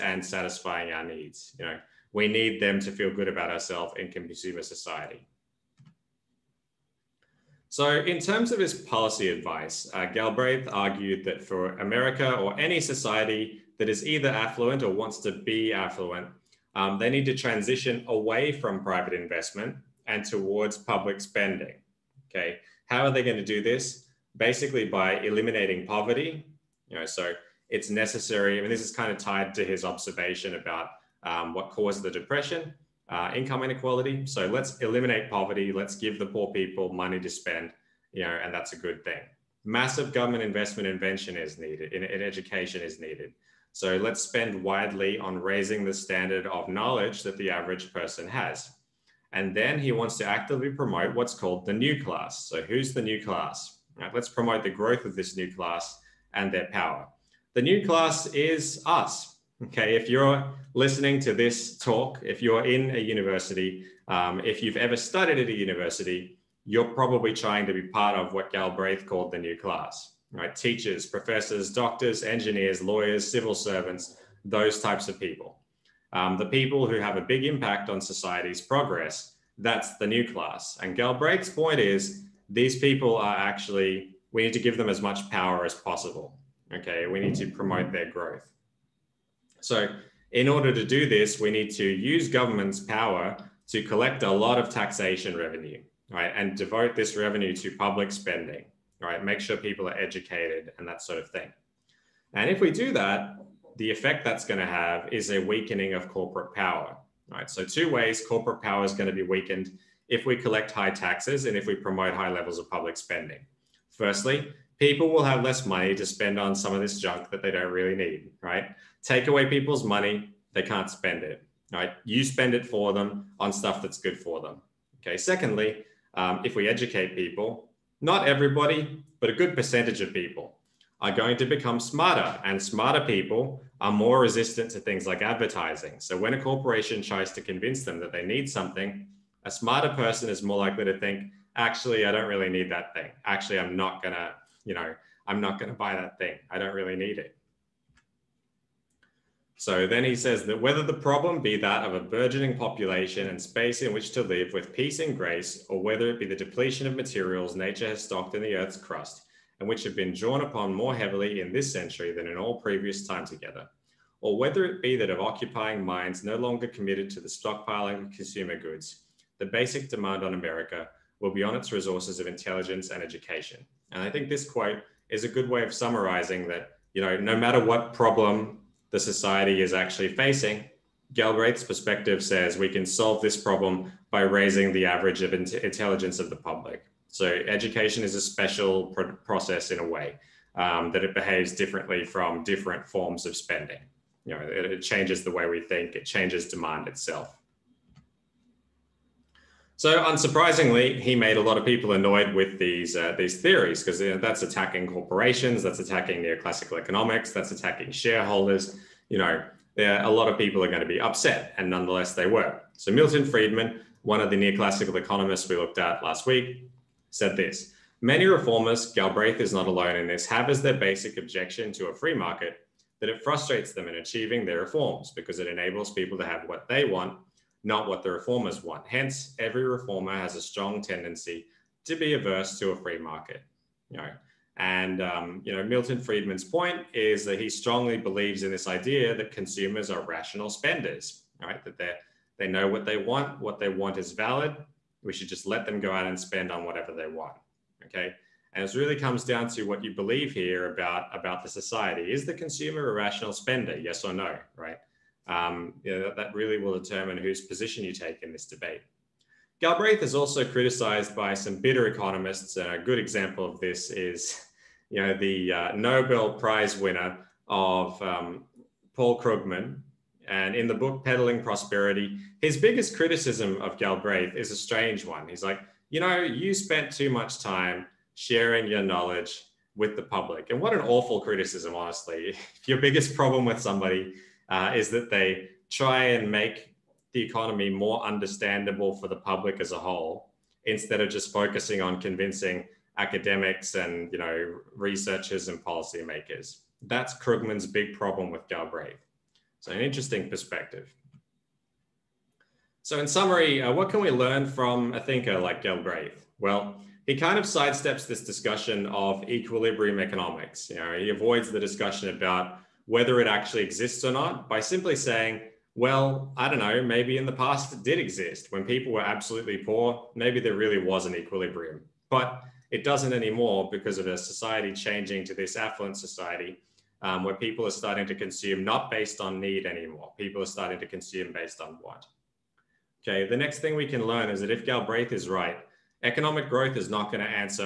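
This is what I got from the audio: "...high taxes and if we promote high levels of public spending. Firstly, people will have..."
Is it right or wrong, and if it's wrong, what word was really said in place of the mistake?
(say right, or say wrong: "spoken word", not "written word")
right.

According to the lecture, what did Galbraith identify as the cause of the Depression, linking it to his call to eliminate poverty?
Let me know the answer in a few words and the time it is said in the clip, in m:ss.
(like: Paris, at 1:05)
income inequality, at 0:33.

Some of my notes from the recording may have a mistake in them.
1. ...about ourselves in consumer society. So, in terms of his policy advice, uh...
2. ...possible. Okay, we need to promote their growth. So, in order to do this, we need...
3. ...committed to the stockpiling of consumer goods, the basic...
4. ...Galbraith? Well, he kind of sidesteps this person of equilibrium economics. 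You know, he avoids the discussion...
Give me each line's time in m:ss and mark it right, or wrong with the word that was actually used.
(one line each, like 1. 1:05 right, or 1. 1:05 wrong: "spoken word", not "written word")
1. 0:03 right
2. 1:25 right
3. 2:46 right
4. 5:05 wrong: "discussion", not "person".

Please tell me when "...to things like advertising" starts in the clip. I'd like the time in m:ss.
2:14.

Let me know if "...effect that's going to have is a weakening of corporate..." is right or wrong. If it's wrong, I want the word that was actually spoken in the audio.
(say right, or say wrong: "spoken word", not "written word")
right.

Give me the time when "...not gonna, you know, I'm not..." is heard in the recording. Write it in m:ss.
2:23.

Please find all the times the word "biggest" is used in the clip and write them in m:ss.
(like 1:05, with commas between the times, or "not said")
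4:32, 4:42.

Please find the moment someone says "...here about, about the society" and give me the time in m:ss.
4:10.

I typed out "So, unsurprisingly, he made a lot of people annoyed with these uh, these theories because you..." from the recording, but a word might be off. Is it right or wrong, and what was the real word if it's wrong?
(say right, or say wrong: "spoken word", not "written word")
right.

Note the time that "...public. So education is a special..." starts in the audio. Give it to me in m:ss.
3:06.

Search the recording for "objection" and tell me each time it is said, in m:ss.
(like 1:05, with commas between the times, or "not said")
3:41.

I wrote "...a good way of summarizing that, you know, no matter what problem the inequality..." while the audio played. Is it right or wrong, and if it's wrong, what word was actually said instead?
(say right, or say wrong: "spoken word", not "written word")
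wrong: "society", not "inequality".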